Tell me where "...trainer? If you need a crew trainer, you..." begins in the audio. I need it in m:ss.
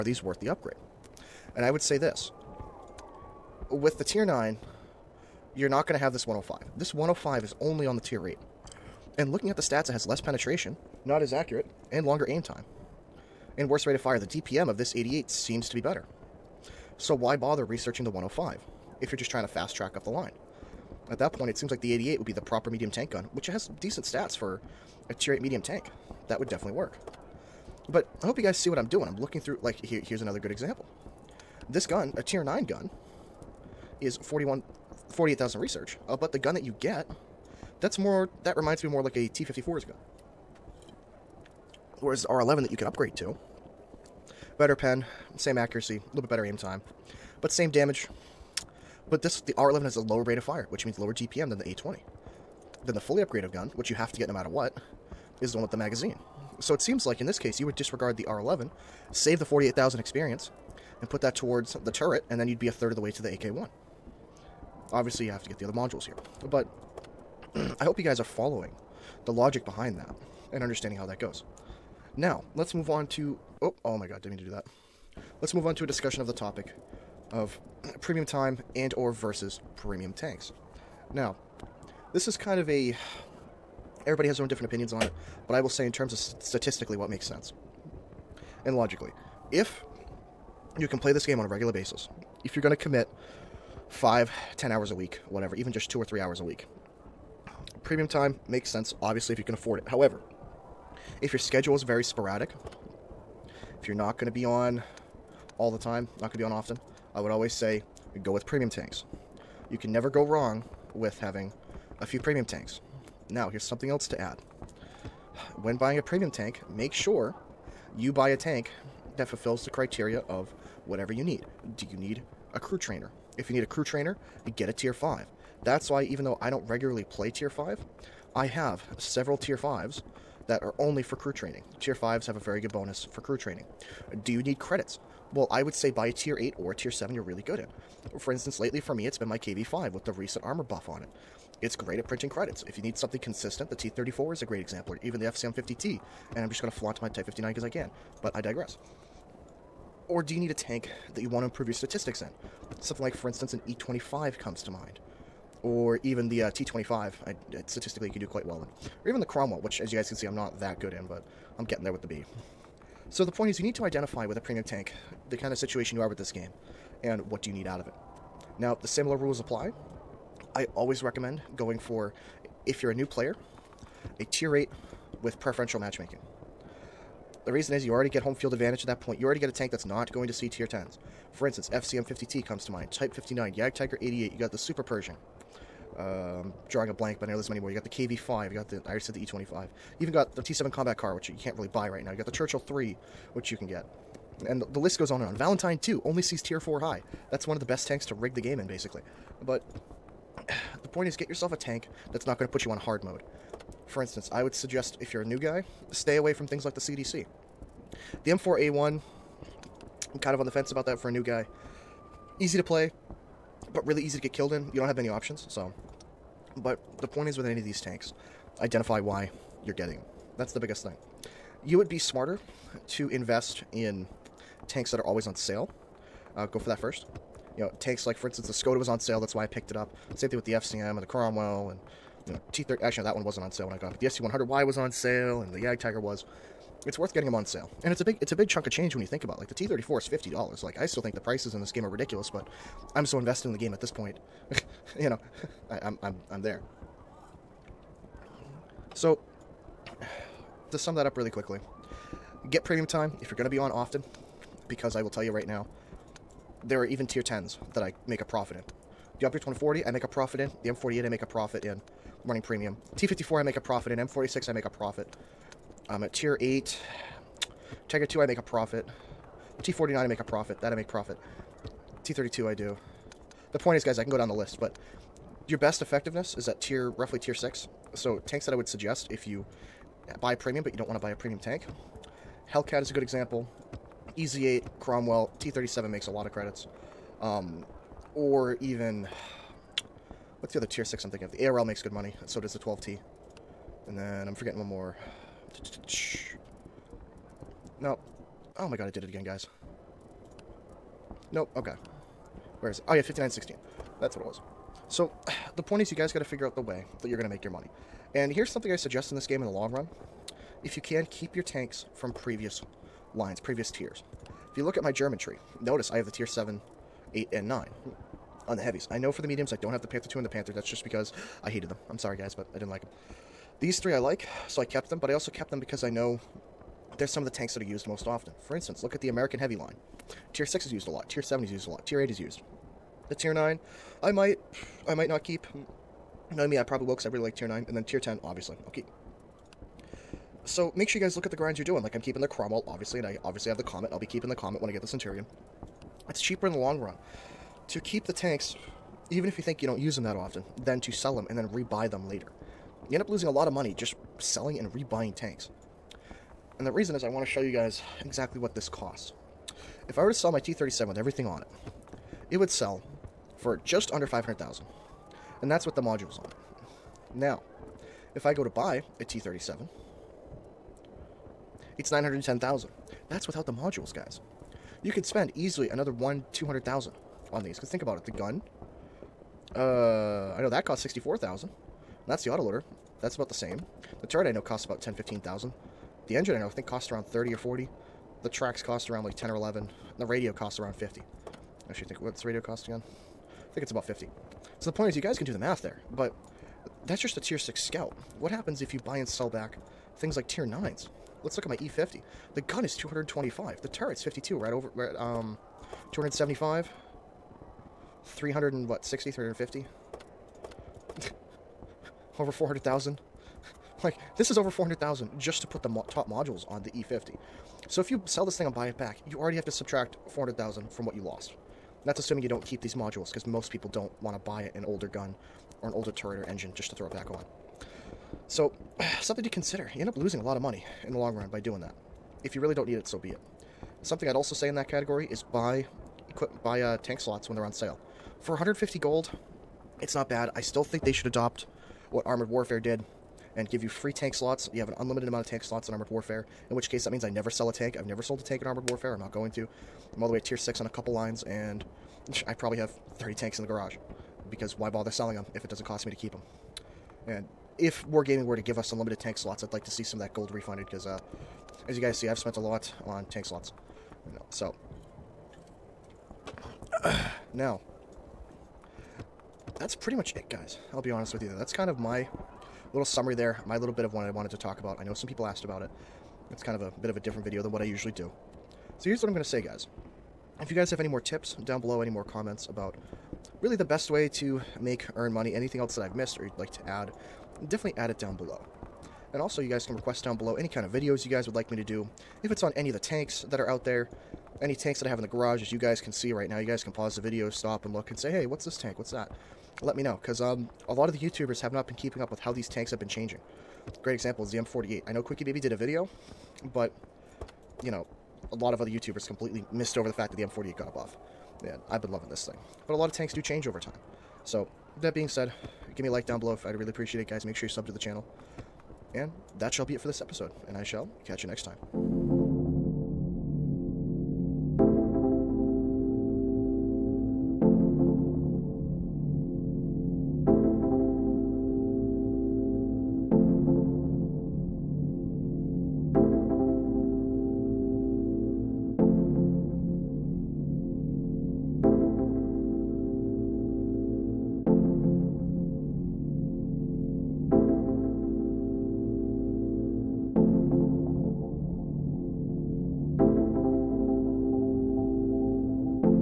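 2:02.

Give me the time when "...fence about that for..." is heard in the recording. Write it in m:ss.
3:30.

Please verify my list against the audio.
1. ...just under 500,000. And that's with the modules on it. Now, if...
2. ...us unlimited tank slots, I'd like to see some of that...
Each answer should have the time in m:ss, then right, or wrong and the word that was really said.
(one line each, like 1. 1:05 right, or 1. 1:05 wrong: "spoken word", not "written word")
1. 6:03 right
2. 7:38 right.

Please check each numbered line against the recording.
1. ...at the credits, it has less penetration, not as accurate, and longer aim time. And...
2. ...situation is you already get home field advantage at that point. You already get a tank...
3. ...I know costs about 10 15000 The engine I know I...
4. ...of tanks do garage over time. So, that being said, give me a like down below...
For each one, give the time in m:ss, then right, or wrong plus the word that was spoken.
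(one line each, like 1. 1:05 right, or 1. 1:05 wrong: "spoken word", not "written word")
1. 0:09 wrong: "stats", not "credits"
2. 2:57 wrong: "reason", not "situation"
3. 6:24 right
4. 8:32 wrong: "change", not "garage".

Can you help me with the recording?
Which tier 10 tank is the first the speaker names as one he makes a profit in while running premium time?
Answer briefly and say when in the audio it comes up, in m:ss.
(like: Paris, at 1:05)
Object 140, at 4:19.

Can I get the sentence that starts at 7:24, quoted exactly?
You have an unlimited amount of tank slots in Armored Warfare, in which case that means I never sell a tank.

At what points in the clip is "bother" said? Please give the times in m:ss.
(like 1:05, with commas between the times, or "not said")
0:17, 7:34.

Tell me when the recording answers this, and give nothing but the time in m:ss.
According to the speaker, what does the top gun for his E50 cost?
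6:42.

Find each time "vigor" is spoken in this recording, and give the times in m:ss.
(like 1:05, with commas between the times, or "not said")
not said.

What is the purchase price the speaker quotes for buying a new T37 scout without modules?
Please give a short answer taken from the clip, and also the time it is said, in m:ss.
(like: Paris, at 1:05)
910,000, at 6:11.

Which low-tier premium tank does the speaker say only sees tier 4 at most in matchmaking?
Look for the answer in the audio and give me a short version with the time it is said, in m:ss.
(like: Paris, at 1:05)
Valentine 2, at 3:15.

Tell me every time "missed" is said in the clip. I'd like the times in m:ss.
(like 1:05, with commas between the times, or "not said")
8:05, 8:29.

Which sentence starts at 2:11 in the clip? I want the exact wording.
Tier 5s have a very good bonus for crew training.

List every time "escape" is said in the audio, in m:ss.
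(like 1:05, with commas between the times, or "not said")
not said.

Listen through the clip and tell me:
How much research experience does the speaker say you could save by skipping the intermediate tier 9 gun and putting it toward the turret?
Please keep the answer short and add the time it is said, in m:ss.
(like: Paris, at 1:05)
48,000, at 0:59.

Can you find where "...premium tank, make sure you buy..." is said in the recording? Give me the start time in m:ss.
1:56.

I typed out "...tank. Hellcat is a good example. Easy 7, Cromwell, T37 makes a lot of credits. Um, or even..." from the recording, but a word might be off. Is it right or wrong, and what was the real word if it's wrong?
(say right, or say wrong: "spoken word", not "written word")
wrong: "8", not "7".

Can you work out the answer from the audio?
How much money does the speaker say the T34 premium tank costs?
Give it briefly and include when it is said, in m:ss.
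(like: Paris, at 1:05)
$50, at 4:00.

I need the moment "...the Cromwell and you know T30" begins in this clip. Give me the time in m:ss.
3:51.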